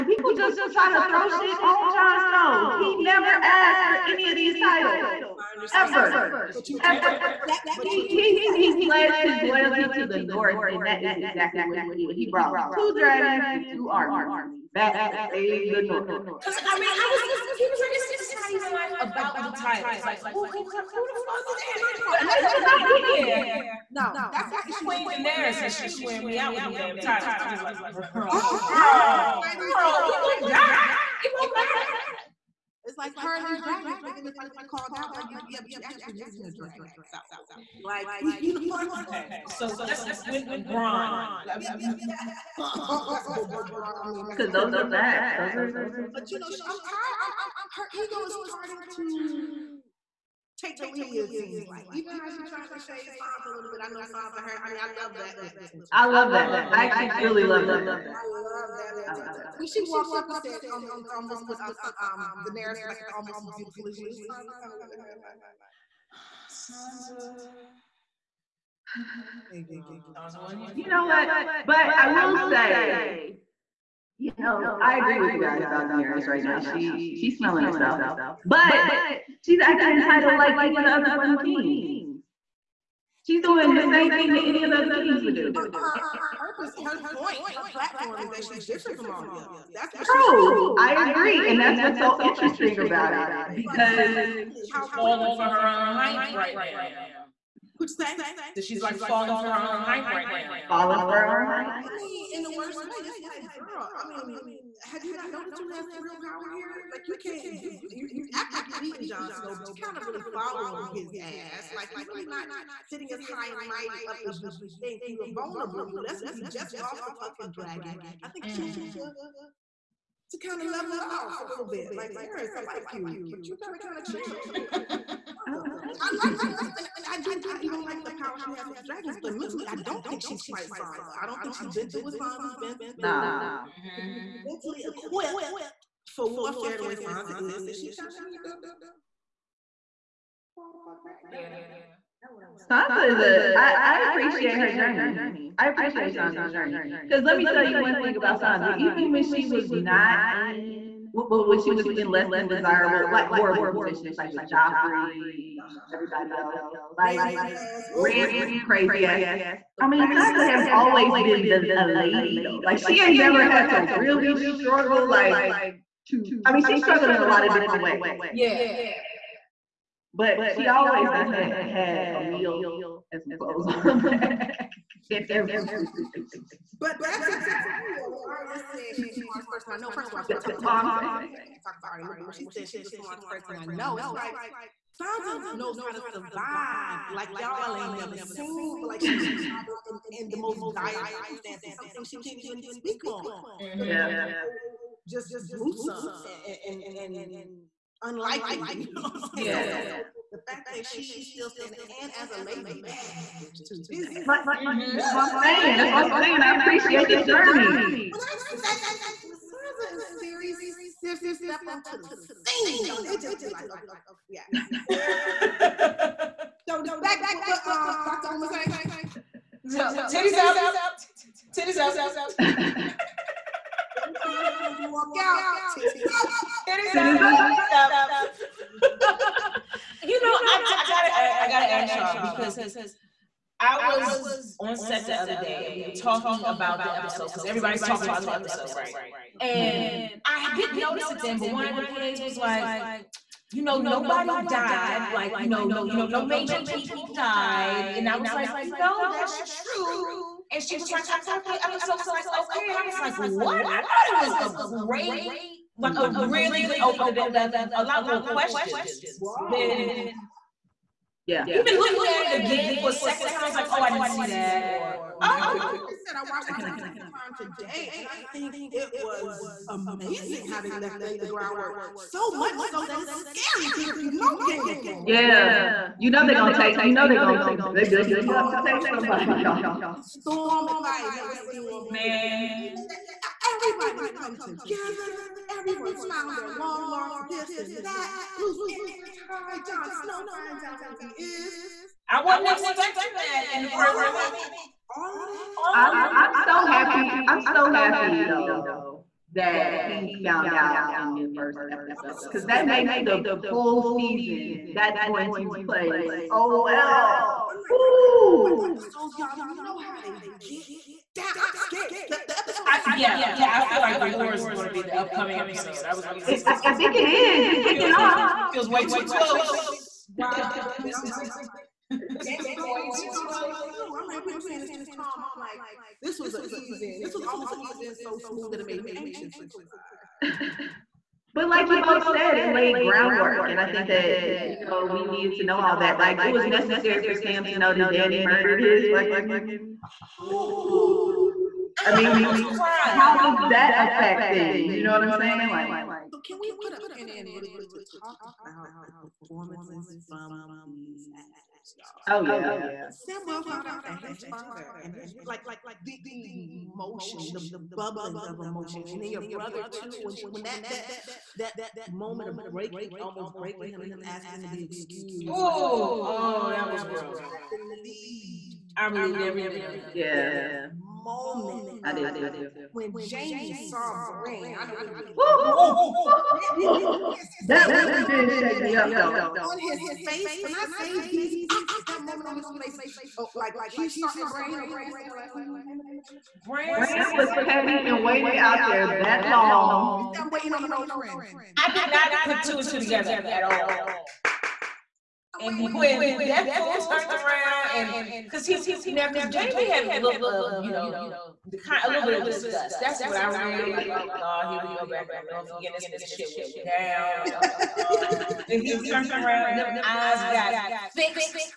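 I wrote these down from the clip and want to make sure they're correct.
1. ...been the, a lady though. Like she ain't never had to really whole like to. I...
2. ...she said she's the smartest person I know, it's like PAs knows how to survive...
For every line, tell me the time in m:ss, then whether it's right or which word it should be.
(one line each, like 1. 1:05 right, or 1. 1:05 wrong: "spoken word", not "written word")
1. 2:41 wrong: "struggle", not "whole"
2. 3:02 wrong: "Sansa", not "PAs".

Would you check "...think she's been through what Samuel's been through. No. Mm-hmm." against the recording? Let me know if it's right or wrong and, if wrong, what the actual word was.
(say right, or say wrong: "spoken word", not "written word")
wrong: "Sansa", not "Samuel".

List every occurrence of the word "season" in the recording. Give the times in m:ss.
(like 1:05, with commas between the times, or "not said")
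5:03.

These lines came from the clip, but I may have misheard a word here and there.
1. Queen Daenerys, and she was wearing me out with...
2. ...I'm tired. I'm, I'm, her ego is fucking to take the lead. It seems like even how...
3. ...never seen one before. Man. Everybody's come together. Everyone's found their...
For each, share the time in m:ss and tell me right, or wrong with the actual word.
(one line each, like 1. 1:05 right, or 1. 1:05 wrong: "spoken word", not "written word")
1. 0:24 right
2. 0:46 wrong: "starting", not "fucking"
3. 4:41 right.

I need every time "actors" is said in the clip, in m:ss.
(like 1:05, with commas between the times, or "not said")
5:51, 6:21.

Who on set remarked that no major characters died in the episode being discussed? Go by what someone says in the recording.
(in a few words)
One of the PAs.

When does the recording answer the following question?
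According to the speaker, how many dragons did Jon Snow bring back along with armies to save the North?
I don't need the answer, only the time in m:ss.
0:12.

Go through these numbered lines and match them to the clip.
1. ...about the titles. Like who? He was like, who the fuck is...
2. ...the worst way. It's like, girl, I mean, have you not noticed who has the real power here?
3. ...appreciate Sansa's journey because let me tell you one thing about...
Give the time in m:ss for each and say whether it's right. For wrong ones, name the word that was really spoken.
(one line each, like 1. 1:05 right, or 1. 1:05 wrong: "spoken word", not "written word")
1. 0:19 right
2. 1:42 right
3. 2:25 right.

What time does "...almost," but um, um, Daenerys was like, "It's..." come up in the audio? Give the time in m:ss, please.
1:01.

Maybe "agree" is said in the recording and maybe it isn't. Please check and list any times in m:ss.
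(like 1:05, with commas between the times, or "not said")
1:14, 1:31.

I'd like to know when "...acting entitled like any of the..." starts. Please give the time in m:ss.
1:19.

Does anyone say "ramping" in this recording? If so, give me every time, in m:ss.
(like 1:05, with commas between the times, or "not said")
2:37.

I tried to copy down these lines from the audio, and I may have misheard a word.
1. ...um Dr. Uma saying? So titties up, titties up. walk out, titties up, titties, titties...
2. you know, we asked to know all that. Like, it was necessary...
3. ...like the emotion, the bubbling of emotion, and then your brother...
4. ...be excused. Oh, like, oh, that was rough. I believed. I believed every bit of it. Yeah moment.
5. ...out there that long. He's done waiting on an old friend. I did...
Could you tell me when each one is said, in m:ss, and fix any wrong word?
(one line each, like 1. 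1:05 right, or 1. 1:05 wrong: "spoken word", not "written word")
1. 3:37 right
2. 5:34 wrong: "needed", not "asked"
3. 5:55 right
4. 6:04 right
5. 6:28 right.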